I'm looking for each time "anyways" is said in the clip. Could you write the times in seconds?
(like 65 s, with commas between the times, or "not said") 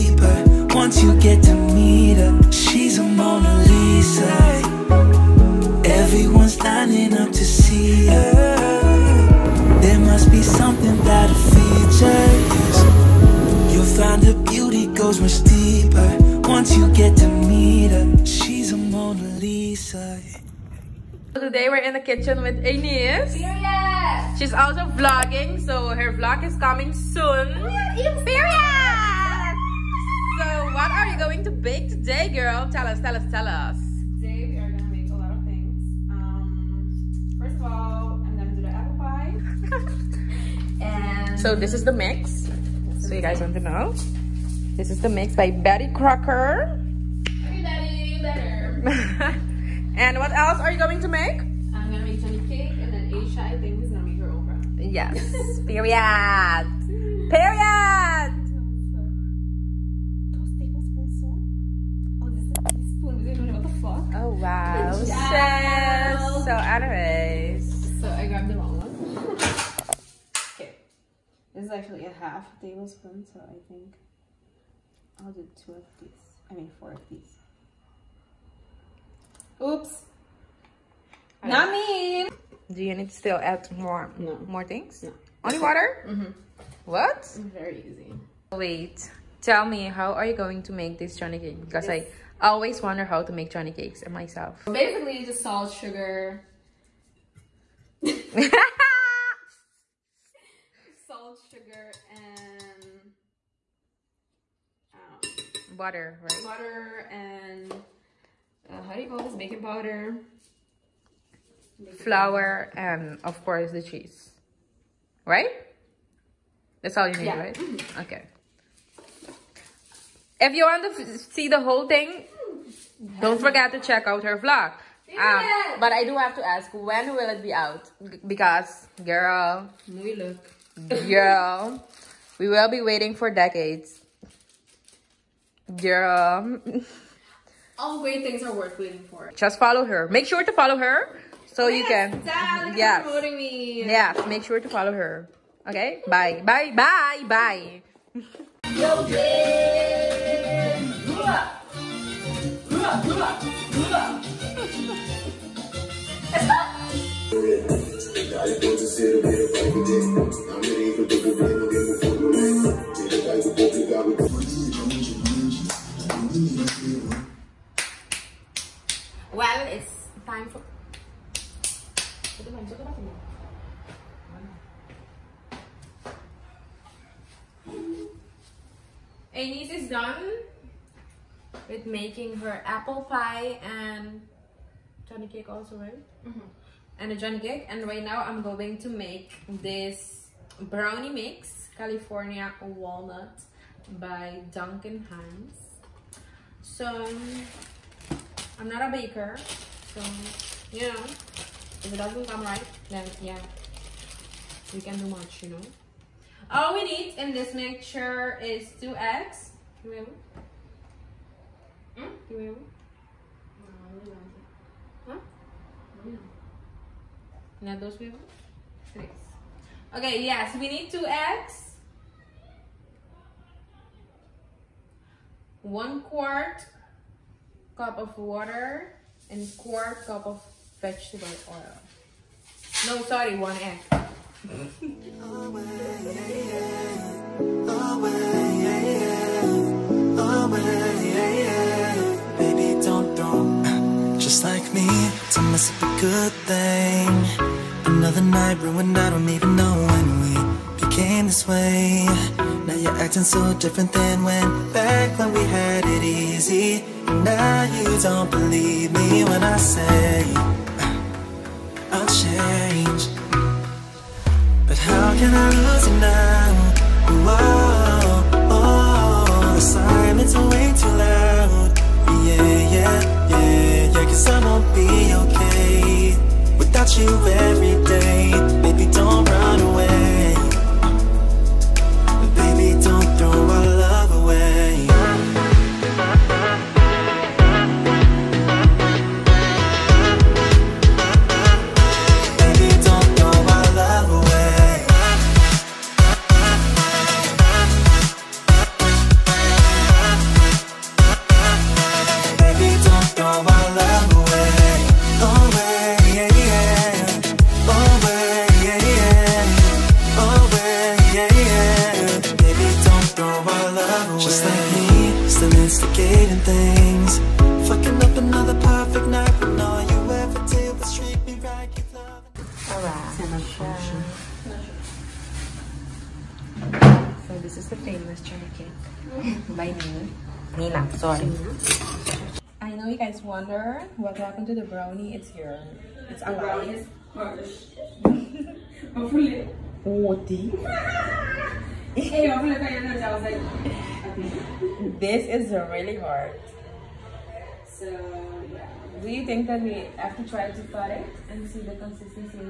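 66 s.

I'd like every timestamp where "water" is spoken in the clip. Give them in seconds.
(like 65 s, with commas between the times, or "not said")
85 s, 228 s.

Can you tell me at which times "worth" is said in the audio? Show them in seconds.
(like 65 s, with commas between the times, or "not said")
138 s.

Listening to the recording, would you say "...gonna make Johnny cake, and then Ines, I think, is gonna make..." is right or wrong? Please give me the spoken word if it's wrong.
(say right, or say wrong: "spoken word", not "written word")
wrong: "Aisha", not "Ines".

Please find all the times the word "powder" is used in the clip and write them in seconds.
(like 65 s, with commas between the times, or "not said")
109 s.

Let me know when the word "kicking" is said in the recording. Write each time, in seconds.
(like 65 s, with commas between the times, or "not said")
not said.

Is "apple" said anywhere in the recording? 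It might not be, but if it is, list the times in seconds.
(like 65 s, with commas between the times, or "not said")
38 s, 182 s.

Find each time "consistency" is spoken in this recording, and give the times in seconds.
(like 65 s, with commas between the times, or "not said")
351 s.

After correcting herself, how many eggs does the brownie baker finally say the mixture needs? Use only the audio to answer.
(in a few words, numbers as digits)
1.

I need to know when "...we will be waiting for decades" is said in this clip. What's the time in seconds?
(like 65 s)
132 s.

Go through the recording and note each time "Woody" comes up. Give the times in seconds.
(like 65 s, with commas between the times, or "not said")
339 s.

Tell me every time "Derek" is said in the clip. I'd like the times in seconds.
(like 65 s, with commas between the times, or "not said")
not said.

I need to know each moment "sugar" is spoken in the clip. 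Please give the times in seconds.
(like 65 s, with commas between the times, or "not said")
95 s, 101 s.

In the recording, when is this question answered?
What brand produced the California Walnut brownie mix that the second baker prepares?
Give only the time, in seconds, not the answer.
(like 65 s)
194 s.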